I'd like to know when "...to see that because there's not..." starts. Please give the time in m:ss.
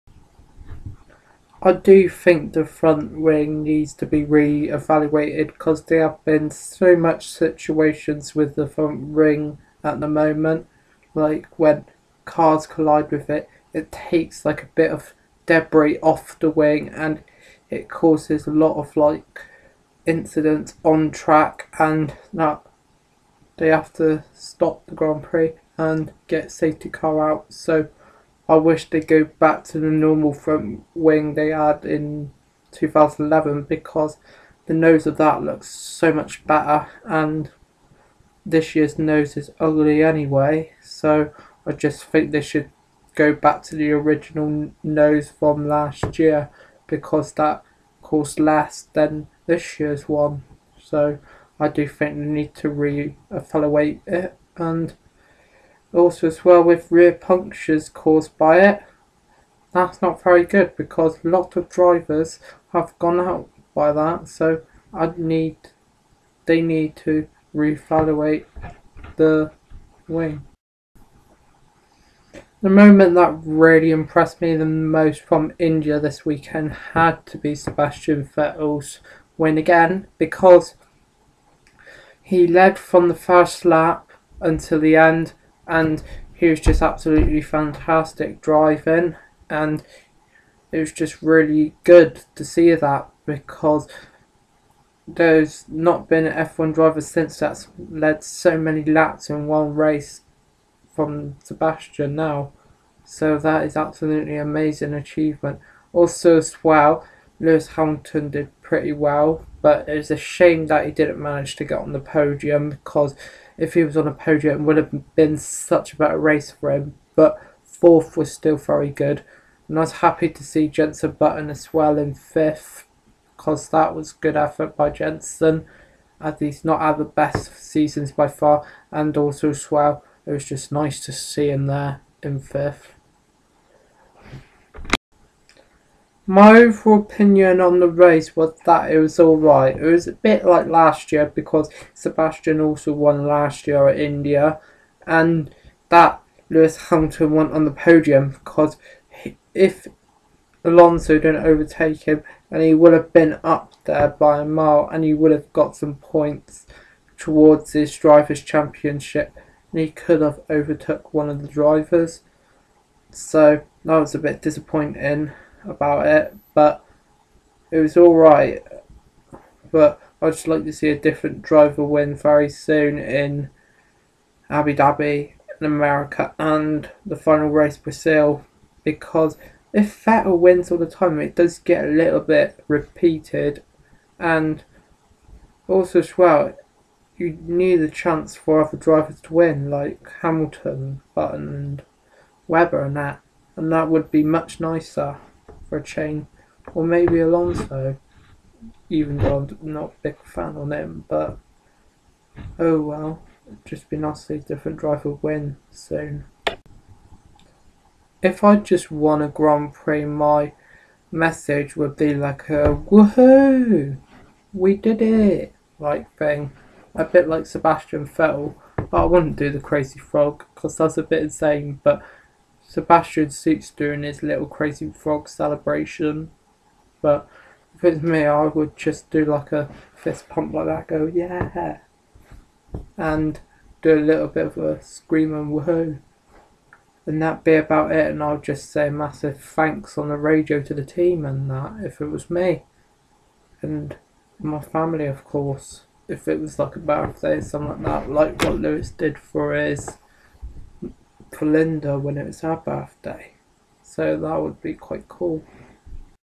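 1:32.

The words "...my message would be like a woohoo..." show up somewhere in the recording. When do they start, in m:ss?
3:30.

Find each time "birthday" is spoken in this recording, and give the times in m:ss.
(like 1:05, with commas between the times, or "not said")
4:06, 4:12.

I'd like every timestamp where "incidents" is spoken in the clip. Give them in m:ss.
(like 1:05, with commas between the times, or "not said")
0:20.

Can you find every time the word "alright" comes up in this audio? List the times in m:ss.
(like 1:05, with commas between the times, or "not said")
2:19, 2:47.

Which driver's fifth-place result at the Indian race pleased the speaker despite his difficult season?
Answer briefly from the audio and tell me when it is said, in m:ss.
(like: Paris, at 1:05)
Jenson Button, at 2:00.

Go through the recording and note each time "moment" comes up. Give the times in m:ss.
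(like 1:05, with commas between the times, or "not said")
0:10, 1:12.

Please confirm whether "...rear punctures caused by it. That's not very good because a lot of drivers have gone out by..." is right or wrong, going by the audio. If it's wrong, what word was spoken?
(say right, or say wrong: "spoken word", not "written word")
right.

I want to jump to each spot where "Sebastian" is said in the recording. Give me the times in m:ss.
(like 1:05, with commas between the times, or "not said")
1:17, 1:41, 2:21, 3:37, 3:42.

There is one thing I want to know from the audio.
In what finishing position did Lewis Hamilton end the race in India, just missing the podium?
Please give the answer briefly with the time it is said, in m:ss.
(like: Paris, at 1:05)
Fourth, at 1:57.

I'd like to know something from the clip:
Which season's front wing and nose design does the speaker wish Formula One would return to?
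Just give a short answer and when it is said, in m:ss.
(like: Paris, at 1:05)
2011, at 0:32.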